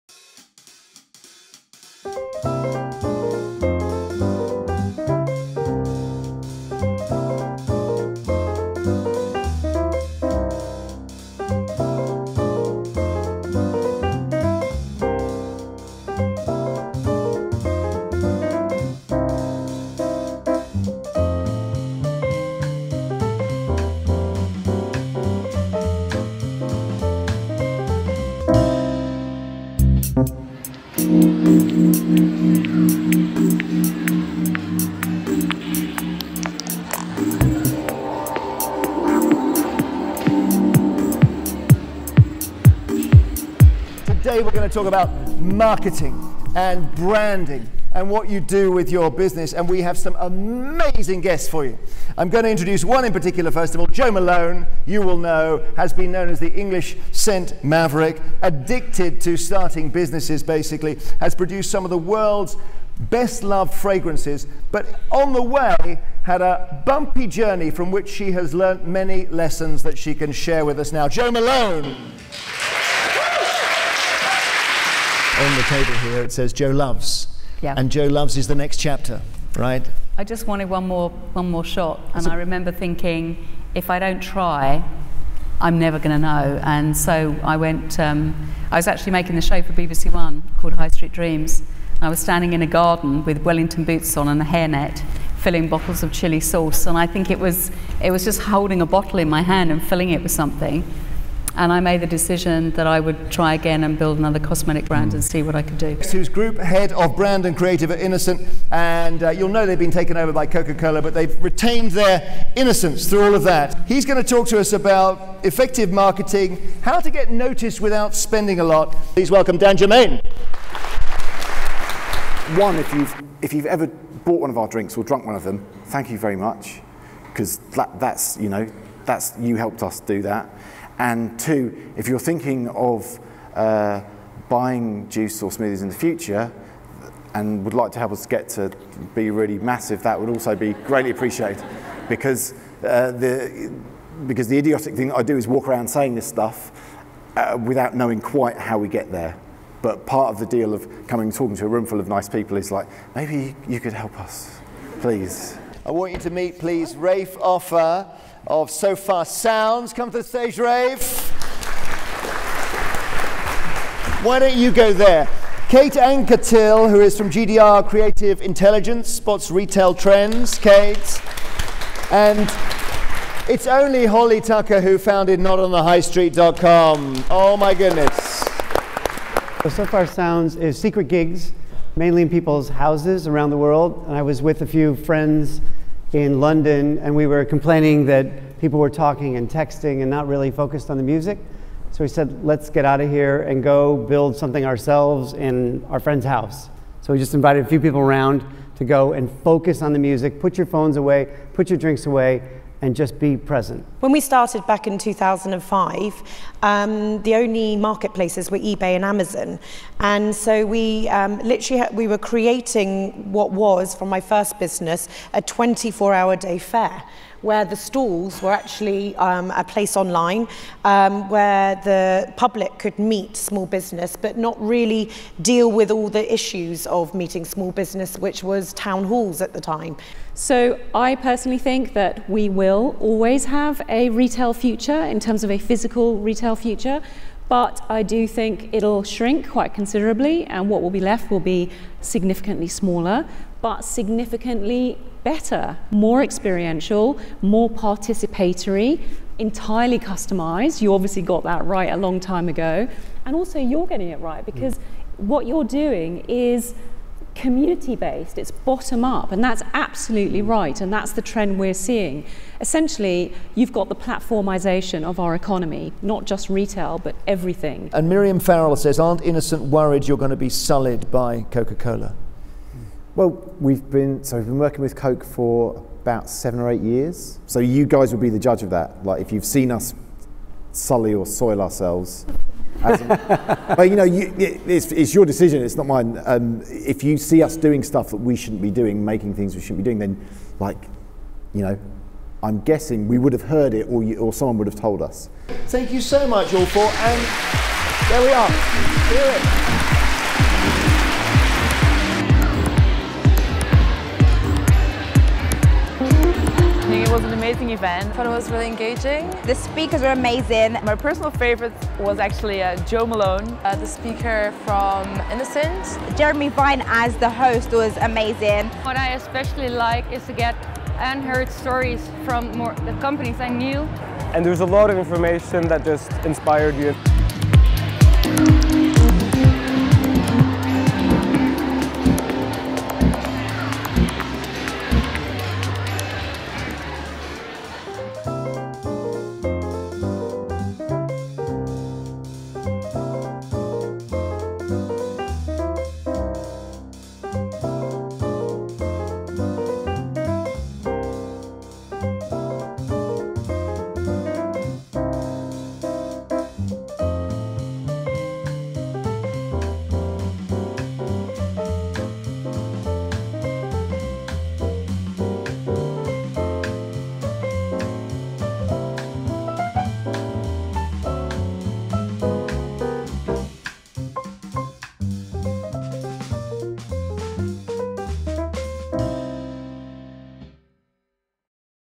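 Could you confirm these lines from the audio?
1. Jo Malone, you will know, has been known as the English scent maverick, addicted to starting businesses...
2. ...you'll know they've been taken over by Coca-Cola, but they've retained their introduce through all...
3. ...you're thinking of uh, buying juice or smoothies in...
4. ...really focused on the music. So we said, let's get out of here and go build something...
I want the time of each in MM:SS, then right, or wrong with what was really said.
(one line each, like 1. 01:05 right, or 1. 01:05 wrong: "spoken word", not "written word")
1. 00:53 right
2. 01:49 wrong: "innocence", not "introduce"
3. 02:12 right
4. 03:10 right.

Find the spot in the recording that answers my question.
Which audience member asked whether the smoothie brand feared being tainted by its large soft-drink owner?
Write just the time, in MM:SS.
04:28.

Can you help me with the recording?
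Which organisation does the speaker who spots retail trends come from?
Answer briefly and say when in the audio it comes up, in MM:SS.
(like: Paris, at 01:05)
GDR Creative Intelligence, at 02:47.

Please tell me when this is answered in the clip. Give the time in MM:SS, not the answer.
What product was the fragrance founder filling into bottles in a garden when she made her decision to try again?
01:36.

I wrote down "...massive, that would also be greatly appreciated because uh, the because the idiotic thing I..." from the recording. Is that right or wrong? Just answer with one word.
right.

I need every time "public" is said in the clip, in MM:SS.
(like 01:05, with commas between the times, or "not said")
03:42.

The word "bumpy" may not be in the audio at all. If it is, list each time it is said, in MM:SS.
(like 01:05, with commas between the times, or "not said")
01:06.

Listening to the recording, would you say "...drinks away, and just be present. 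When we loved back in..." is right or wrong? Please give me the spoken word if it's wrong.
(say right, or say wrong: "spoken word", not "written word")
wrong: "started", not "loved".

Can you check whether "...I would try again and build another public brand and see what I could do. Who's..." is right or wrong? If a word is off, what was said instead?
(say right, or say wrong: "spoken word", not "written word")
wrong: "cosmetic", not "public".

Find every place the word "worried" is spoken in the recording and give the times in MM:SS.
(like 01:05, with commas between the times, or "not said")
04:29.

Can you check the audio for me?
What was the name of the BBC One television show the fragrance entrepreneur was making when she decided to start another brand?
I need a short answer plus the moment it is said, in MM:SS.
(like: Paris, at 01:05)
High Street Dreams, at 01:30.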